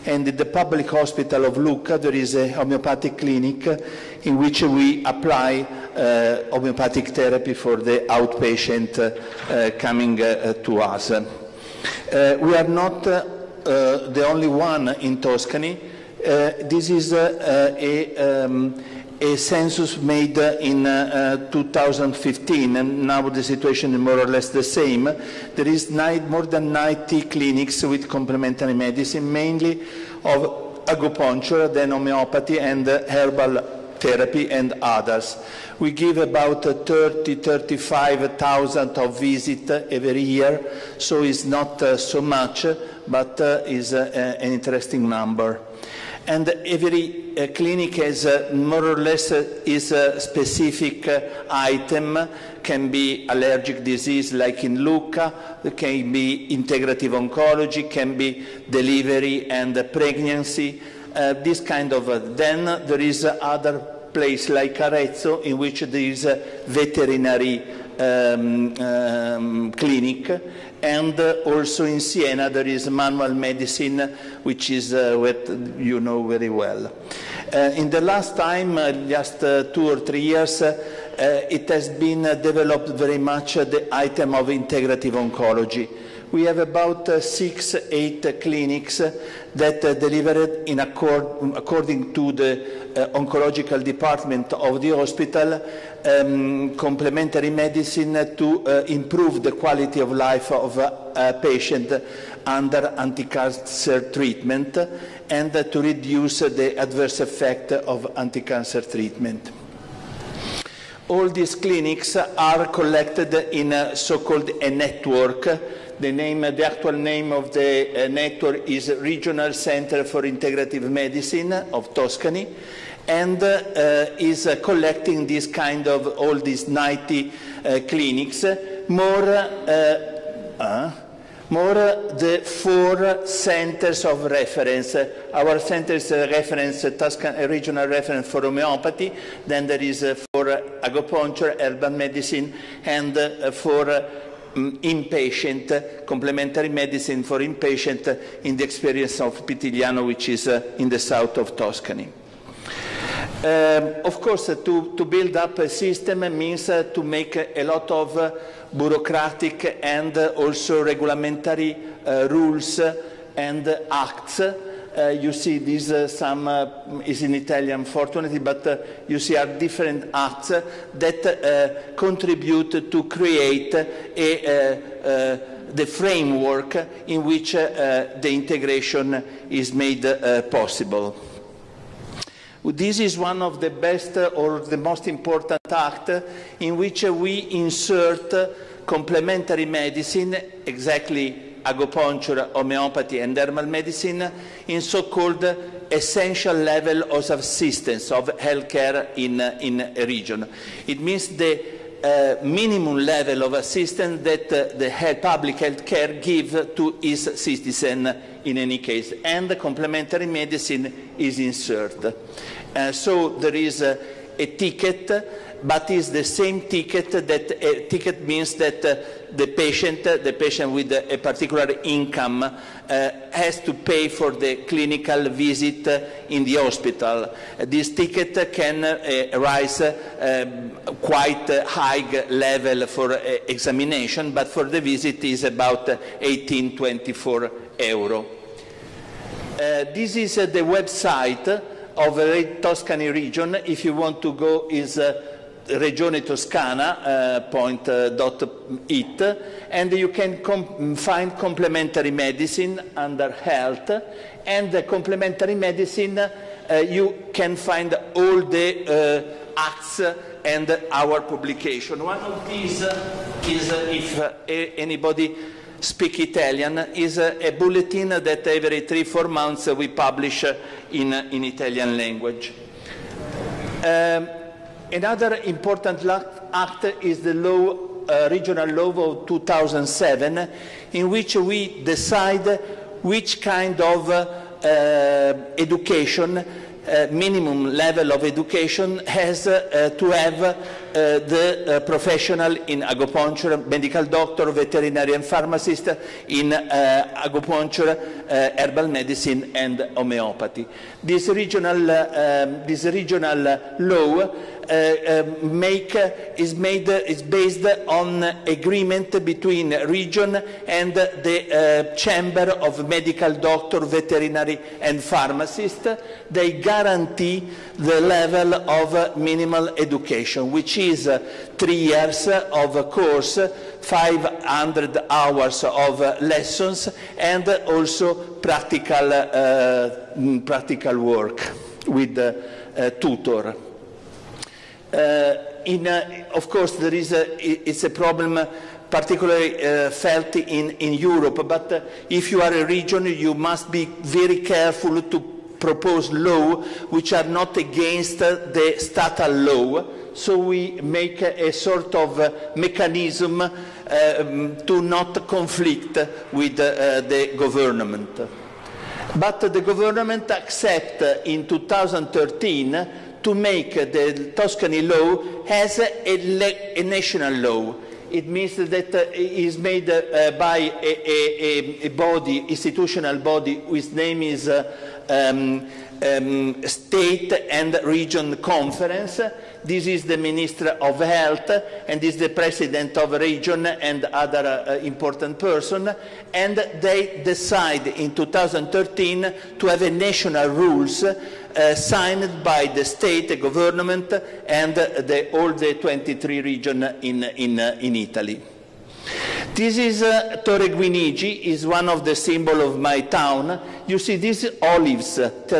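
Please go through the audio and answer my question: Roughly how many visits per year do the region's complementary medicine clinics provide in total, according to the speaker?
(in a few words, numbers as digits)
30-35,000.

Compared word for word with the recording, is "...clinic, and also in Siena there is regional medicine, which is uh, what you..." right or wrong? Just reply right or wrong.
wrong.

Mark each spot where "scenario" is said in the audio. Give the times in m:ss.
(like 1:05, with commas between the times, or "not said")
not said.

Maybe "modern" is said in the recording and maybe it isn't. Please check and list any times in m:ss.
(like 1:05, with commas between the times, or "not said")
not said.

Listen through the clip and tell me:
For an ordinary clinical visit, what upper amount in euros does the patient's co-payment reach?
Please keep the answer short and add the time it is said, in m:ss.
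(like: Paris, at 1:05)
24 euro, at 3:56.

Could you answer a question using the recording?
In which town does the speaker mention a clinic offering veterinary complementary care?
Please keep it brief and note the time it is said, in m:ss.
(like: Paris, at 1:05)
Arezzo, at 1:04.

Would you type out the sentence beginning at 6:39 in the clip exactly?
This is uh, Torre Guinigi, is one of the symbol of my town.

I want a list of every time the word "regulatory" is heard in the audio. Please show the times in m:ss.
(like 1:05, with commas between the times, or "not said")
2:40.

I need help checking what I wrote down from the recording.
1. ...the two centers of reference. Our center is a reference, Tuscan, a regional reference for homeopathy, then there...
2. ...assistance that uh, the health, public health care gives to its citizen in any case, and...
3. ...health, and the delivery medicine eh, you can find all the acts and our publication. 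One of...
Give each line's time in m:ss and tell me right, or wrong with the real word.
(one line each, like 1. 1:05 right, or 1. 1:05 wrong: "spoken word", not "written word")
1. 2:12 wrong: "four", not "two"
2. 3:23 right
3. 4:13 wrong: "complementary", not "delivery".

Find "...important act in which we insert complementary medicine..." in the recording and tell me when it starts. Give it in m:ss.
3:05.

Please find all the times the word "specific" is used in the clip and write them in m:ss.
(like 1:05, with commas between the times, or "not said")
0:50.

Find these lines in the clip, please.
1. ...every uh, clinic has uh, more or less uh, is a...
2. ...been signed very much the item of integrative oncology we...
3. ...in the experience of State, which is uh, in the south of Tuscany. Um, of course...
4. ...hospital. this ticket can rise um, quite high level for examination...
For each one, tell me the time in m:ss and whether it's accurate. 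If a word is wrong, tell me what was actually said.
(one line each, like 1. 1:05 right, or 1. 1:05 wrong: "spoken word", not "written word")
1. 0:46 right
2. 1:21 wrong: "developed", not "signed"
3. 2:28 wrong: "Pitigliano", not "State"
4. 3:46 right.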